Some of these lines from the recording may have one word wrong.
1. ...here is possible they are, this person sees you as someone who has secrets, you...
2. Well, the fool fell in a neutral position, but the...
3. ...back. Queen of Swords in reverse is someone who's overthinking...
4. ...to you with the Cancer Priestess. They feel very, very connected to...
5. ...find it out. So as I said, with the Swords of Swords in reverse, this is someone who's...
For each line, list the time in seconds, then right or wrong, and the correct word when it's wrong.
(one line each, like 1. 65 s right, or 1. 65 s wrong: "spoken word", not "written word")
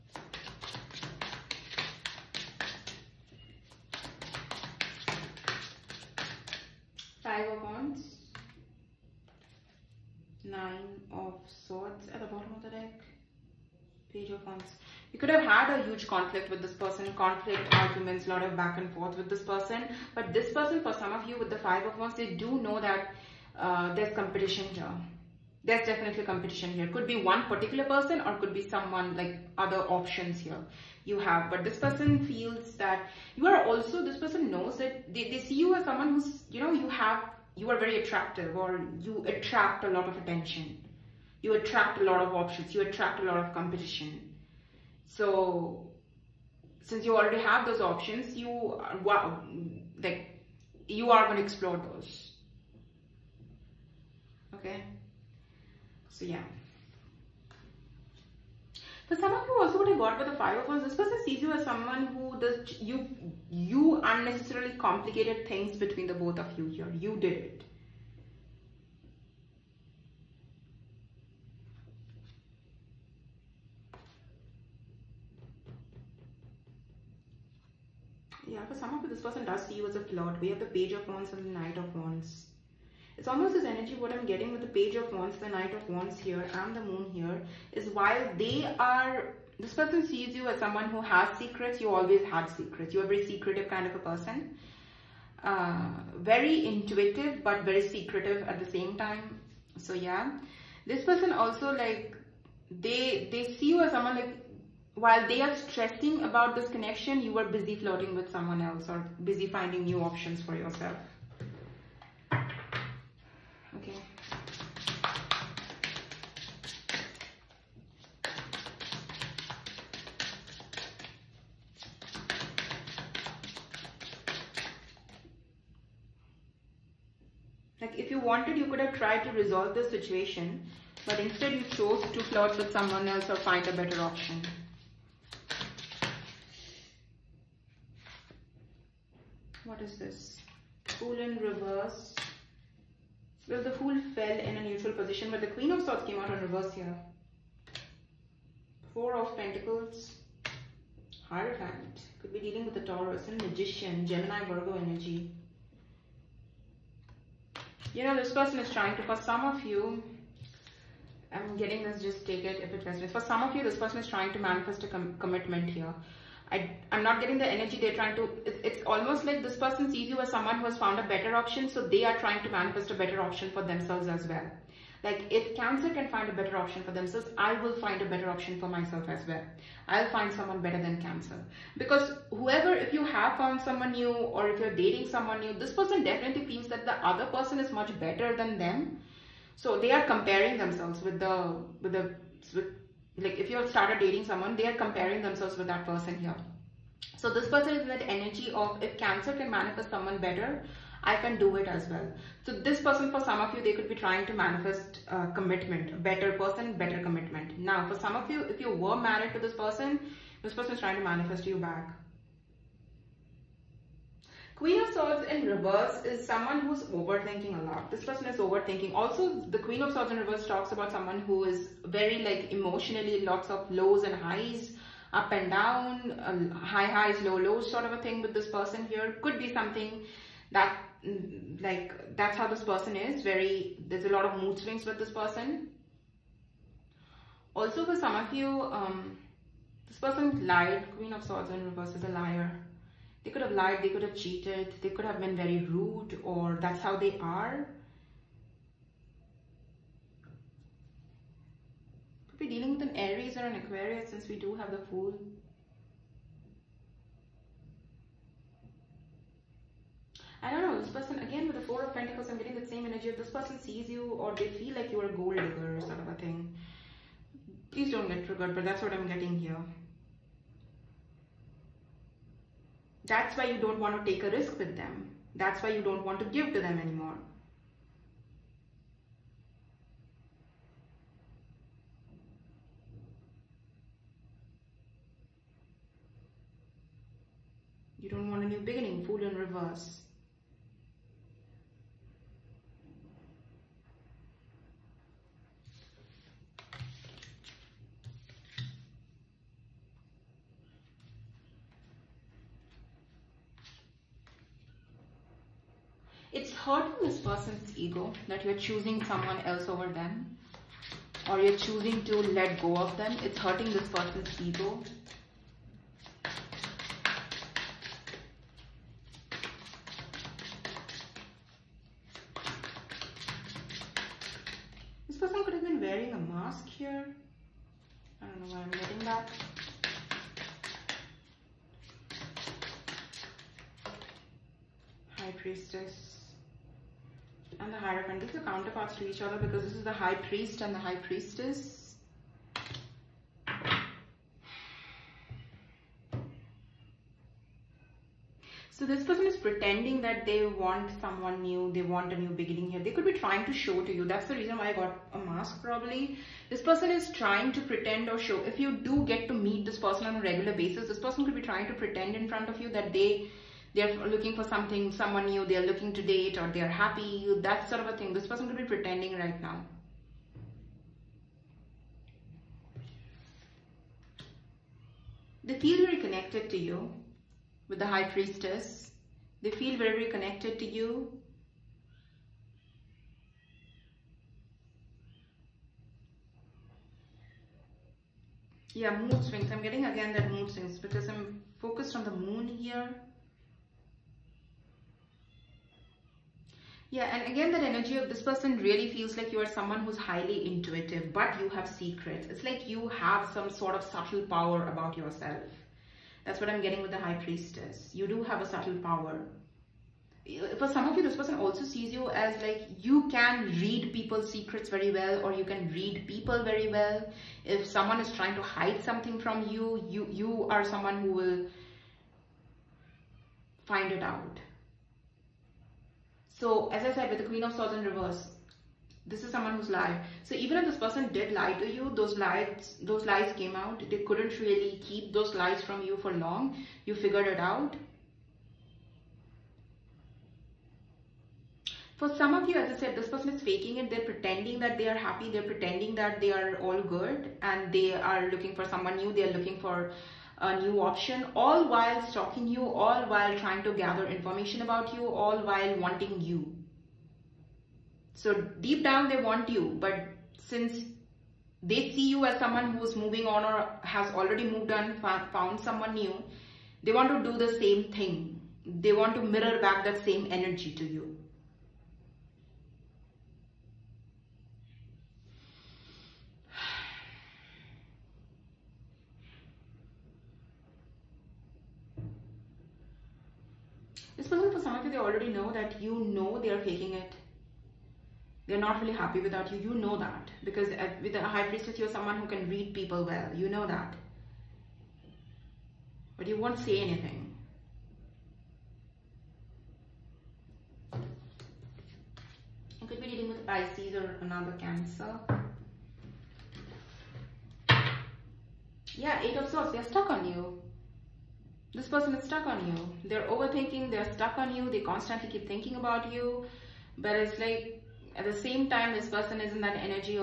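1. 87 s wrong: "while", not "possible"
2. 143 s right
3. 211 s right
4. 376 s wrong: "High", not "Cancer"
5. 423 s wrong: "Queen", not "Swords".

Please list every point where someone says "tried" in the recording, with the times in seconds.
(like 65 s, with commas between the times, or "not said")
128 s.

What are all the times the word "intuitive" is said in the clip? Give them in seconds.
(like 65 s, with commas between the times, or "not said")
96 s, 400 s.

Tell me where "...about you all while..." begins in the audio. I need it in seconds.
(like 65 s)
454 s.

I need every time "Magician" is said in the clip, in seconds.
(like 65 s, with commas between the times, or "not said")
153 s.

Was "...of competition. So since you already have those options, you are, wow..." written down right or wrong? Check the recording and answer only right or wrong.
right.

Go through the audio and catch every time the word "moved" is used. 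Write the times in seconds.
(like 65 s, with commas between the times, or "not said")
464 s.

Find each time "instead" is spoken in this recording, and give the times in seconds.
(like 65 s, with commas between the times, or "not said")
131 s.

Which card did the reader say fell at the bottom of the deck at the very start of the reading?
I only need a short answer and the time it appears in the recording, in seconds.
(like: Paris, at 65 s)
Nine of Swords, at 10 s.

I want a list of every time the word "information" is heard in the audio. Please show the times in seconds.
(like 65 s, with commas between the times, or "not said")
454 s.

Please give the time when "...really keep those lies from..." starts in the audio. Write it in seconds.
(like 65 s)
434 s.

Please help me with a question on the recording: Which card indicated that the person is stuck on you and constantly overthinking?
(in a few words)
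Eight of Swords.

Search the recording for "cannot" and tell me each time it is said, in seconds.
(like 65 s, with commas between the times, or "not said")
not said.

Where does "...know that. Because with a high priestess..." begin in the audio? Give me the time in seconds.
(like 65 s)
489 s.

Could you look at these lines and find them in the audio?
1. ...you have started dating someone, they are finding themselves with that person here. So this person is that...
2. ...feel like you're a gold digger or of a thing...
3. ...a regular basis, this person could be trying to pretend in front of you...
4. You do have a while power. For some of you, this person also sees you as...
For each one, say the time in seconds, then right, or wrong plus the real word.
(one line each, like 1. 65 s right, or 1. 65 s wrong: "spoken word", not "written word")
1. 193 s wrong: "comparing", not "finding"
2. 264 s right
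3. 360 s right
4. 407 s wrong: "subtle", not "while".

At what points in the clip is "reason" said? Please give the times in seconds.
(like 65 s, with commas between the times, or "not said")
354 s.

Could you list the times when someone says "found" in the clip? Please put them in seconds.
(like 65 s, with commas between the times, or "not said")
170 s, 183 s, 465 s.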